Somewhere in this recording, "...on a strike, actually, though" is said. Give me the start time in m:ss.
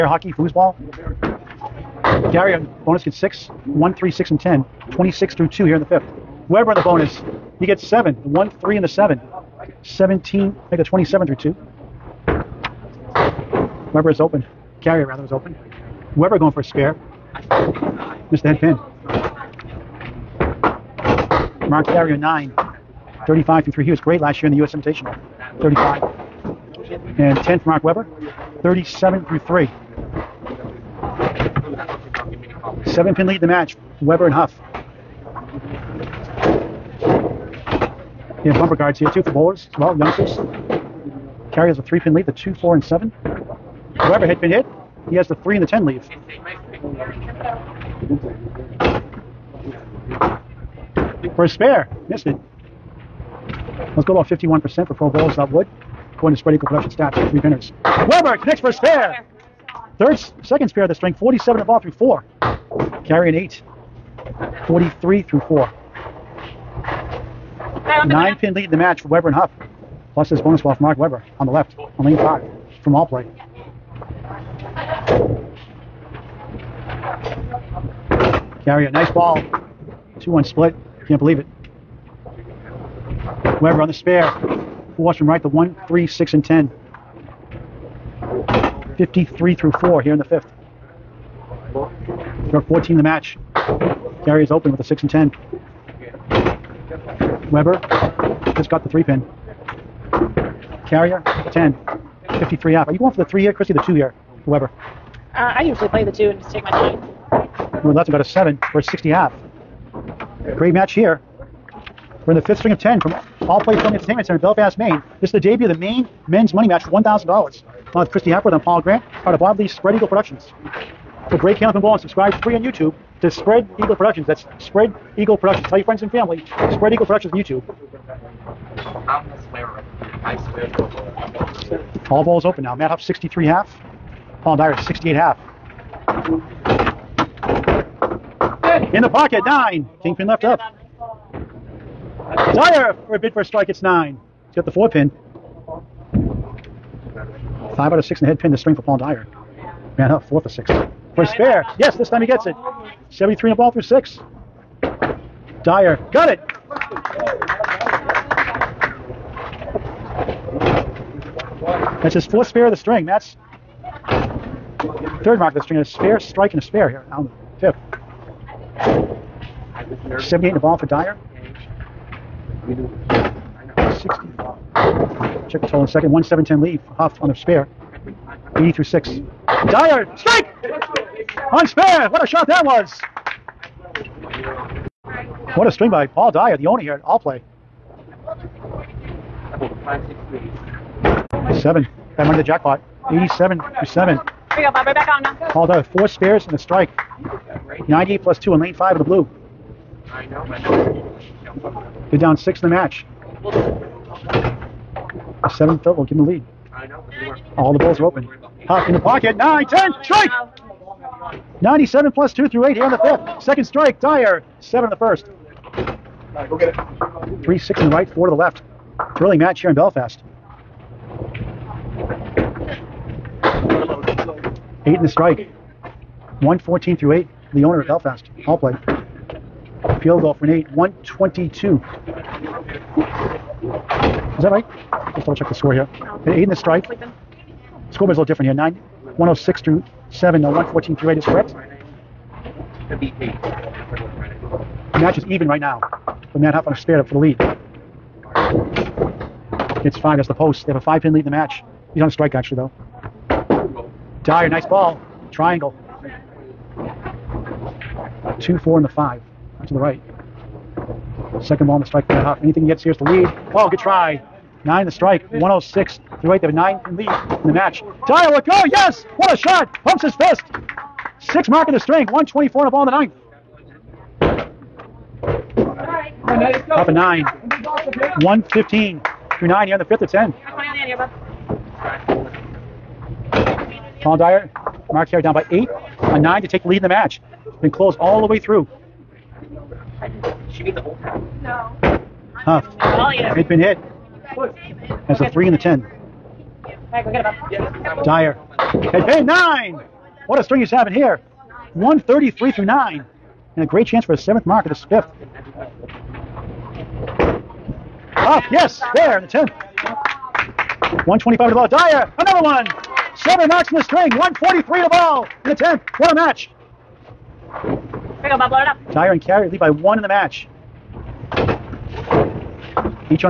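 4:12.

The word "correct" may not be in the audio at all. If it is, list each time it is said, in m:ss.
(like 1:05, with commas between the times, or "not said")
4:01.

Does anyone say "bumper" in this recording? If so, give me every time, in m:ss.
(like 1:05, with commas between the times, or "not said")
0:38.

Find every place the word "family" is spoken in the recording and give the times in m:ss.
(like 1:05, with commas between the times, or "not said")
1:53, 2:06.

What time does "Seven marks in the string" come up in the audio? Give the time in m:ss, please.
5:13.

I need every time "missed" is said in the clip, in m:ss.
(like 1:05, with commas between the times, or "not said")
0:18, 0:52.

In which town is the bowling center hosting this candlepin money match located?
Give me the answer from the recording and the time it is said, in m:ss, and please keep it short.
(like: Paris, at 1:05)
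Belfast, Maine, at 1:54.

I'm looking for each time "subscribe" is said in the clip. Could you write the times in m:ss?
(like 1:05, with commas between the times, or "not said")
2:01.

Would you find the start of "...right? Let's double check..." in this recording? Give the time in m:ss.
3:54.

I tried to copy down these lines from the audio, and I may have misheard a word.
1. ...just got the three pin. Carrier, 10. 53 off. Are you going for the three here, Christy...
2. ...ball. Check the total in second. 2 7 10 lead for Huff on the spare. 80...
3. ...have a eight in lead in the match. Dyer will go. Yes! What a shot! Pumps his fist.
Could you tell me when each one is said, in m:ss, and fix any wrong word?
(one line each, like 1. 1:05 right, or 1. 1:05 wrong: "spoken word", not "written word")
1. 1:38 right
2. 2:54 wrong: "1", not "2"
3. 4:26 wrong: "nine", not "eight".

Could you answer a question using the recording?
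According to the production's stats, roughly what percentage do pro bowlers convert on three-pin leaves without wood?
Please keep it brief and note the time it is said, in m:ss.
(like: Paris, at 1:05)
51%, at 0:54.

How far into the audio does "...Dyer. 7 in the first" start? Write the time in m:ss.
3:33.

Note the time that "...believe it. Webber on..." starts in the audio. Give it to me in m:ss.
1:21.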